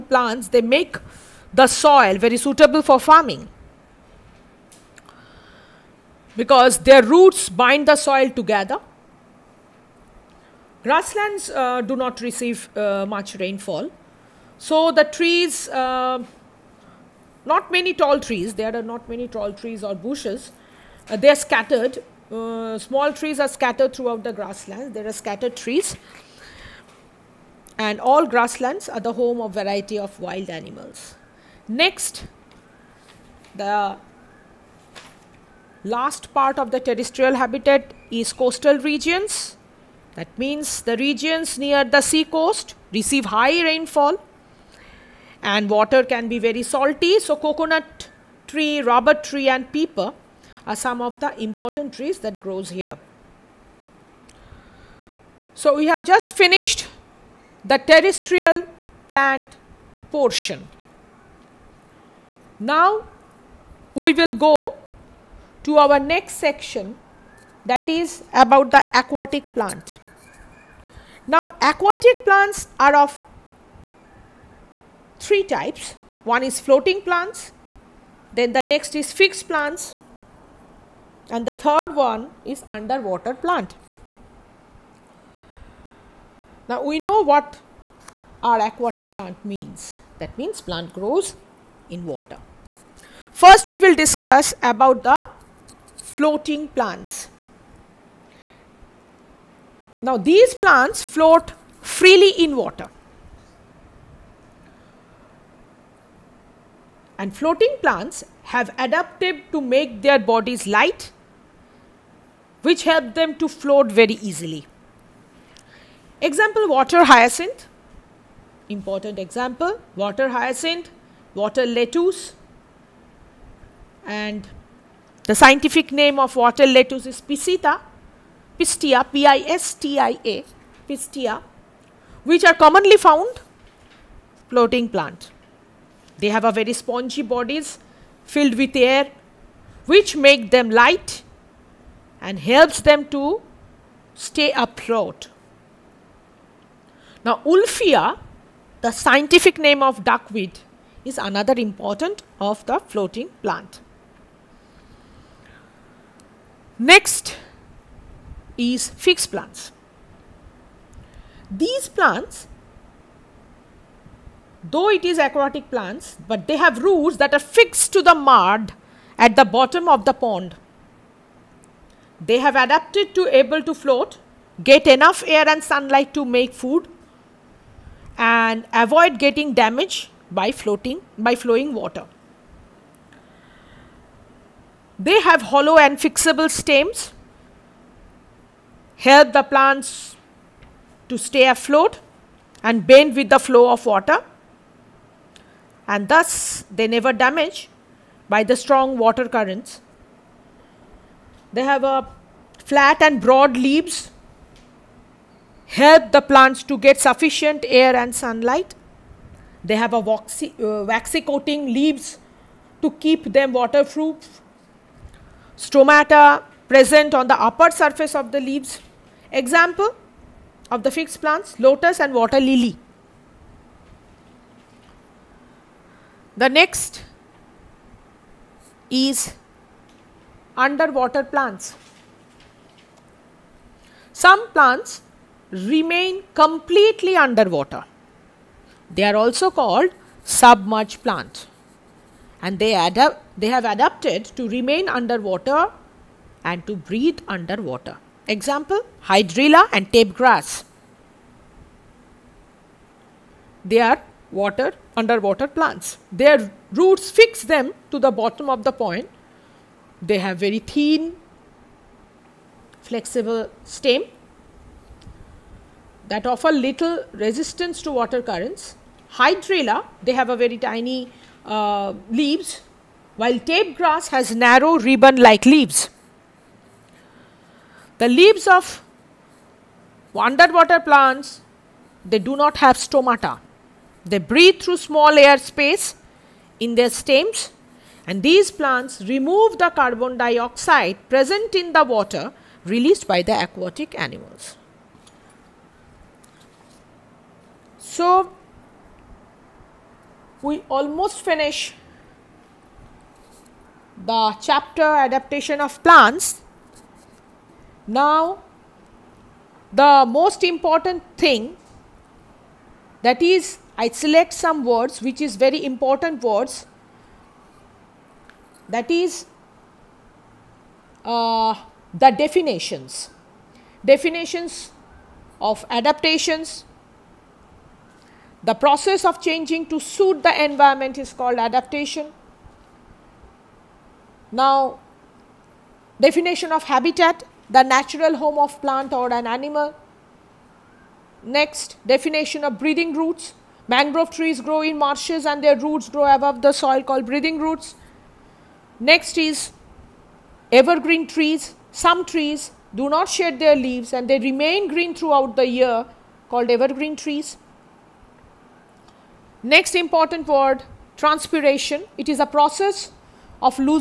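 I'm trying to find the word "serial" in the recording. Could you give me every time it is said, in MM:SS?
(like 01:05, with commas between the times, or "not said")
not said.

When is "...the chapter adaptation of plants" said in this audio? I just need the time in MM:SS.
05:04.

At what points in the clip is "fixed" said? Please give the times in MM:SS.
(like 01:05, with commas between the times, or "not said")
01:19, 02:38, 02:47, 03:40.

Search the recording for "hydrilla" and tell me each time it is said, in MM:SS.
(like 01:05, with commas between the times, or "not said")
04:09, 04:29.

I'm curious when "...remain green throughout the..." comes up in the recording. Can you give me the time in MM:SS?
05:54.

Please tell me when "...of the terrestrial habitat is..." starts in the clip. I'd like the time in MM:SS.
00:36.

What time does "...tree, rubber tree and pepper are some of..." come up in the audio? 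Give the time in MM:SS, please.
00:48.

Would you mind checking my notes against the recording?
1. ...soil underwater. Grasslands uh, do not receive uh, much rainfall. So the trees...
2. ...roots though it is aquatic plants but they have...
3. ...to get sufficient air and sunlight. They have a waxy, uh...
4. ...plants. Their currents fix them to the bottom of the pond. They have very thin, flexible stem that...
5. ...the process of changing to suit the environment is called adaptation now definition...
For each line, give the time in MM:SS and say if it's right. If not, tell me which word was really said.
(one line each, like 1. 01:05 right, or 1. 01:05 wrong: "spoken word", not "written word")
1. 00:07 wrong: "together", not "underwater"
2. 02:41 wrong: "plants", not "roots"
3. 03:26 right
4. 04:15 wrong: "roots", not "currents"
5. 05:28 right.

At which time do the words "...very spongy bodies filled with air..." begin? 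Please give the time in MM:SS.
02:16.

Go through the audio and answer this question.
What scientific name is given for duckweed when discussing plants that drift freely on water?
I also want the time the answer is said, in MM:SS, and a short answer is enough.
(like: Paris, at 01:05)
Wolffia, at 02:27.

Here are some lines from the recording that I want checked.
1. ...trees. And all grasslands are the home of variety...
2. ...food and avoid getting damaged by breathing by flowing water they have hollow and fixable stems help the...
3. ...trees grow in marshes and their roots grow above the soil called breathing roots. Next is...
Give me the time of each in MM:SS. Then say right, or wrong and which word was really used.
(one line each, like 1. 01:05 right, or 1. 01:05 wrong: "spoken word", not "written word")
1. 00:25 right
2. 02:56 wrong: "floating", not "breathing"
3. 05:44 right.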